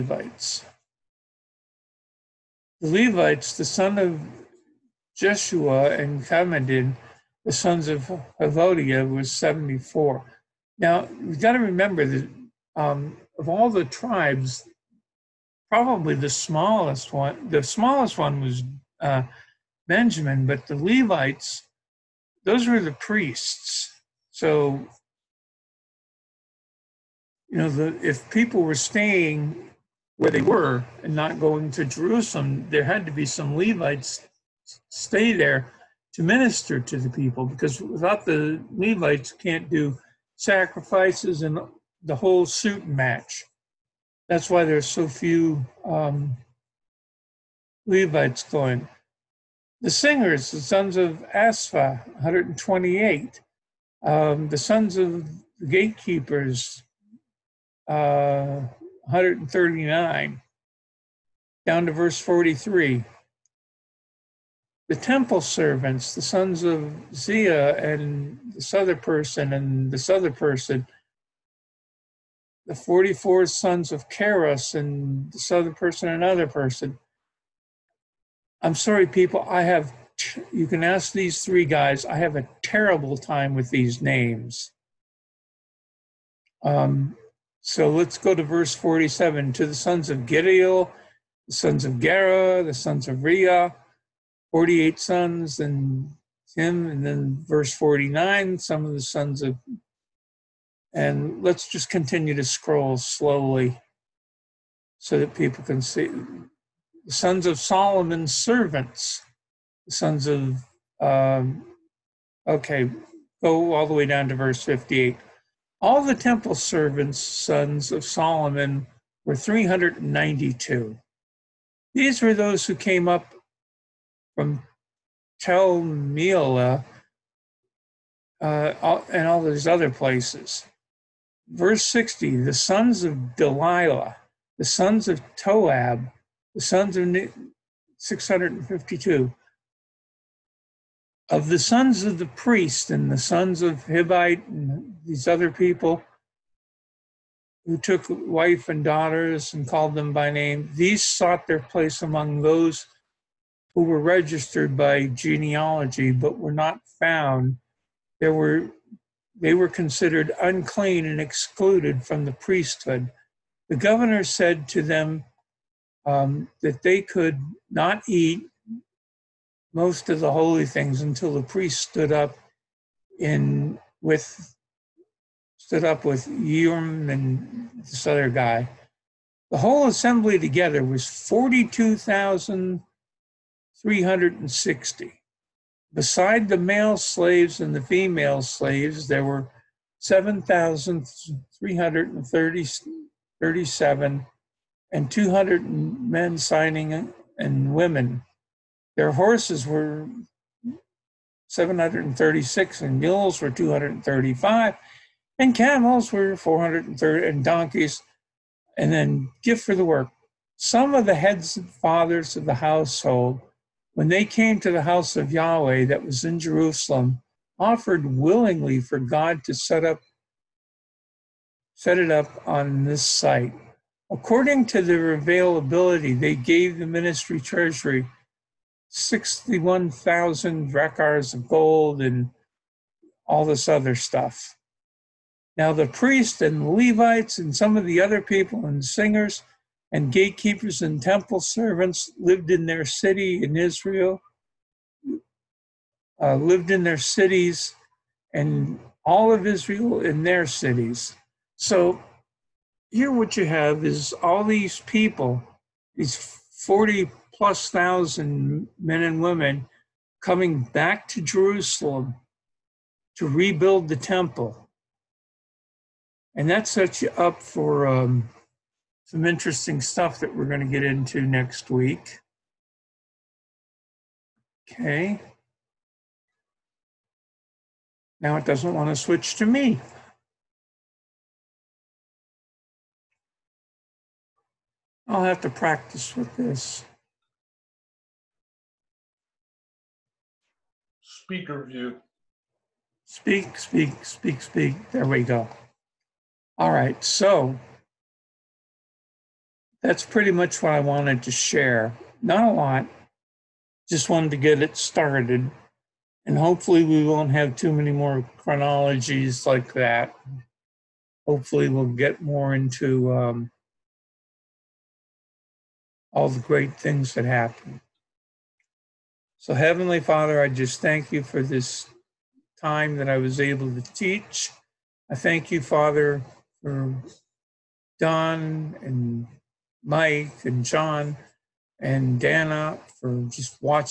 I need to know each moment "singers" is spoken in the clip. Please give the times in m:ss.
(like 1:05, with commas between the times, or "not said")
0:49, 3:58.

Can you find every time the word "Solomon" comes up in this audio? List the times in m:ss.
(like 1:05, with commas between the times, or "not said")
1:47, 1:58.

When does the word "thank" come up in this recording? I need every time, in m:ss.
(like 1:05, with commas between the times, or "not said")
5:20, 5:25.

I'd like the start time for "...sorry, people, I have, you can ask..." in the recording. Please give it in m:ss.
1:18.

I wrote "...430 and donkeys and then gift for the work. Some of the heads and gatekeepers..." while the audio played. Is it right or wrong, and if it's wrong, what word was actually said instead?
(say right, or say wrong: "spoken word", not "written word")
wrong: "fathers", not "gatekeepers".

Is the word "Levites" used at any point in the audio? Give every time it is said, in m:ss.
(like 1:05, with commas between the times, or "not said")
0:02, 0:20, 0:33, 0:38, 0:47, 3:56.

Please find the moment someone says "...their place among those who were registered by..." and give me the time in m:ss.
2:31.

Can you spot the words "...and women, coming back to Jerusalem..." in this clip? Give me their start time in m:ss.
4:19.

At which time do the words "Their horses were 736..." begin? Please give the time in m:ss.
3:18.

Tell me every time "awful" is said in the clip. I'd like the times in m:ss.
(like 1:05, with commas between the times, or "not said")
not said.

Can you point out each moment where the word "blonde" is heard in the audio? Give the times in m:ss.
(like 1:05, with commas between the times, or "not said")
not said.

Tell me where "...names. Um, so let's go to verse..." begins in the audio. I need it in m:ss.
1:24.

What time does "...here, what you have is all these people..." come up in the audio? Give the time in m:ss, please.
4:12.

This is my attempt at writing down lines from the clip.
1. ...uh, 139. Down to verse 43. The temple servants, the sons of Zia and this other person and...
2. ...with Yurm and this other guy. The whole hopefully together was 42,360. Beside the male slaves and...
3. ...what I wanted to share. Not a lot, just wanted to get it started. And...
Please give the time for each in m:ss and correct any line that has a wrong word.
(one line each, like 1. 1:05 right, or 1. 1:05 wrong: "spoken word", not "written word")
1. 0:57 right
2. 2:56 wrong: "assembly", not "hopefully"
3. 5:00 right.